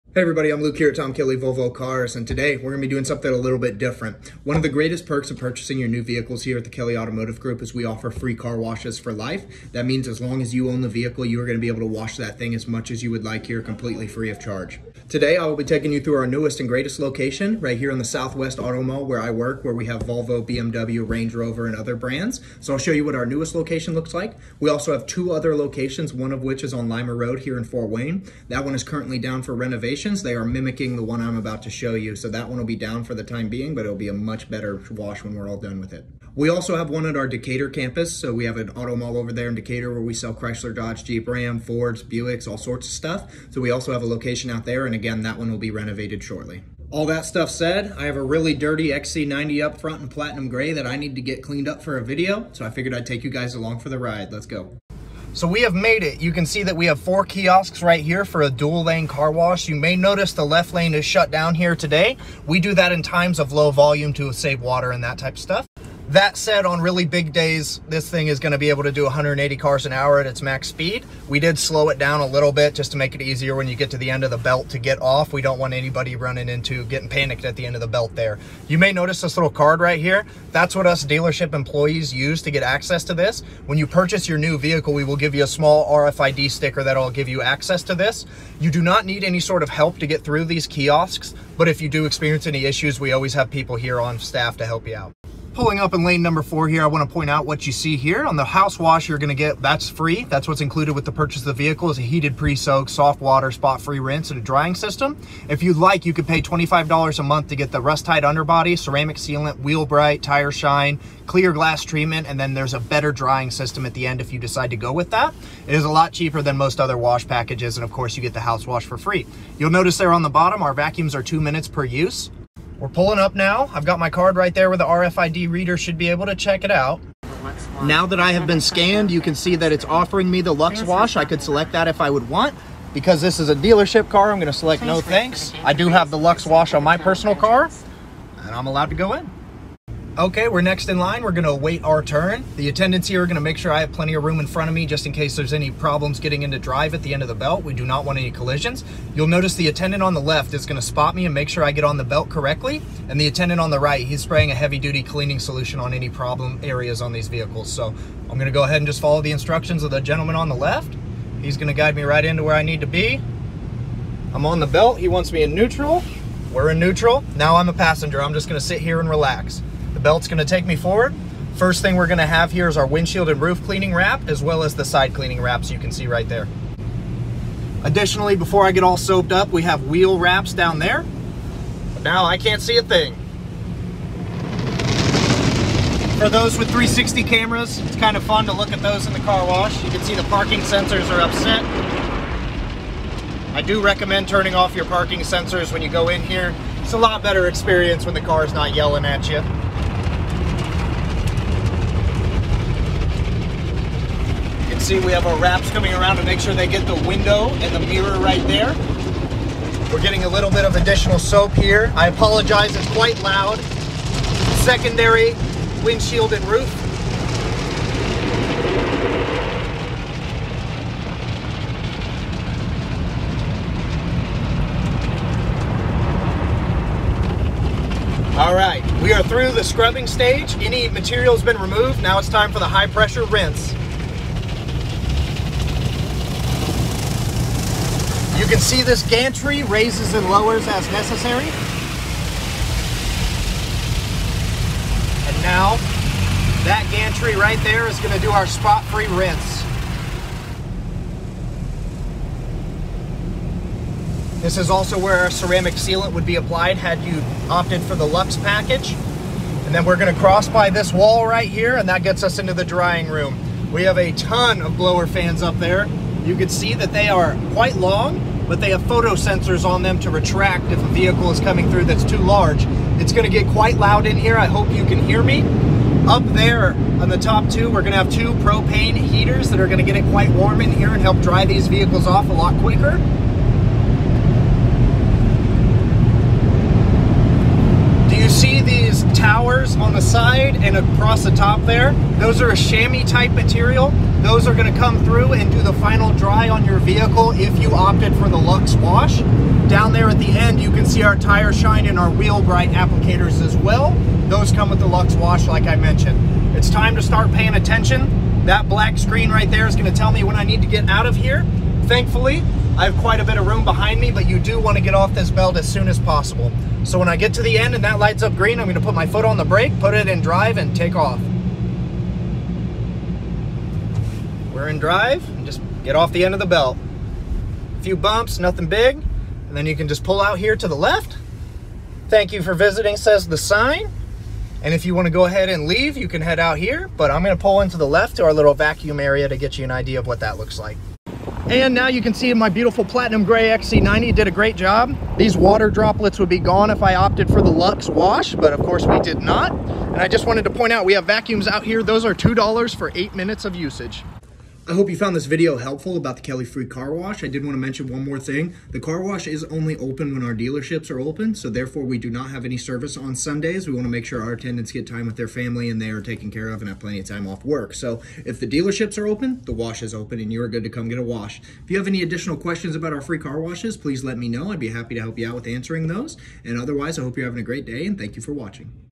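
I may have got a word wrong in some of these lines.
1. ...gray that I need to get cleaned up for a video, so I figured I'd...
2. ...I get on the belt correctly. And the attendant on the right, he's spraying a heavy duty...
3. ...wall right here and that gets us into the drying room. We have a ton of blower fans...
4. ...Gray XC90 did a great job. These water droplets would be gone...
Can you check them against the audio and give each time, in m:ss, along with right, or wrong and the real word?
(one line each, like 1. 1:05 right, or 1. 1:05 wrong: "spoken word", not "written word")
1. 0:50 right
2. 2:31 right
3. 4:20 right
4. 5:43 right.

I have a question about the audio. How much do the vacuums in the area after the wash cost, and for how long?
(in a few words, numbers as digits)
$2 for 8 minutes.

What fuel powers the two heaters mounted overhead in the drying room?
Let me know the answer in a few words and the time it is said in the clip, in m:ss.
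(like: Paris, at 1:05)
Propane, at 4:38.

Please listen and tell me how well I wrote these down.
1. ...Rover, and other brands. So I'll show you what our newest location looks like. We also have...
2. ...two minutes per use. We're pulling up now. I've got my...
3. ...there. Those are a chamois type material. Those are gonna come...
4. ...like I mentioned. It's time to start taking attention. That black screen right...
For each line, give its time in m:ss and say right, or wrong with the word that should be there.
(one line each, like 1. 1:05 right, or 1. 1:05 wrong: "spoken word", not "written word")
1. 0:21 right
2. 2:01 right
3. 4:51 right
4. 5:05 wrong: "paying", not "taking".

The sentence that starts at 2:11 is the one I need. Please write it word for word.
I could select that if I would want.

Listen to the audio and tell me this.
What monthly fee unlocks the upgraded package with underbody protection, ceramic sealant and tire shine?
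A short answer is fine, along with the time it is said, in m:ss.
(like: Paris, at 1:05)
$25, at 1:46.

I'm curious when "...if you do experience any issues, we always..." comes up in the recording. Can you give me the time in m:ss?
1:31.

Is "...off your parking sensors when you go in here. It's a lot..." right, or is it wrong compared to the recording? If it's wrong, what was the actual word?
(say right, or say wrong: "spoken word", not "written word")
right.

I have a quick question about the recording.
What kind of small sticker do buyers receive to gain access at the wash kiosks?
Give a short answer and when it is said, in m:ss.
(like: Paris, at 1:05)
RFID sticker, at 1:25.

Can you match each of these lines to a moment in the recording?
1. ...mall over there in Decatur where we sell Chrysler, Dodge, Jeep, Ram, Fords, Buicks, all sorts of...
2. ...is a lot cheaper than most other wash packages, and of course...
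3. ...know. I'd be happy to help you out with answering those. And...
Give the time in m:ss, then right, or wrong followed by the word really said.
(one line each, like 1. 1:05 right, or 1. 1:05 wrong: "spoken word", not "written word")
1. 0:38 right
2. 1:55 right
3. 6:14 right.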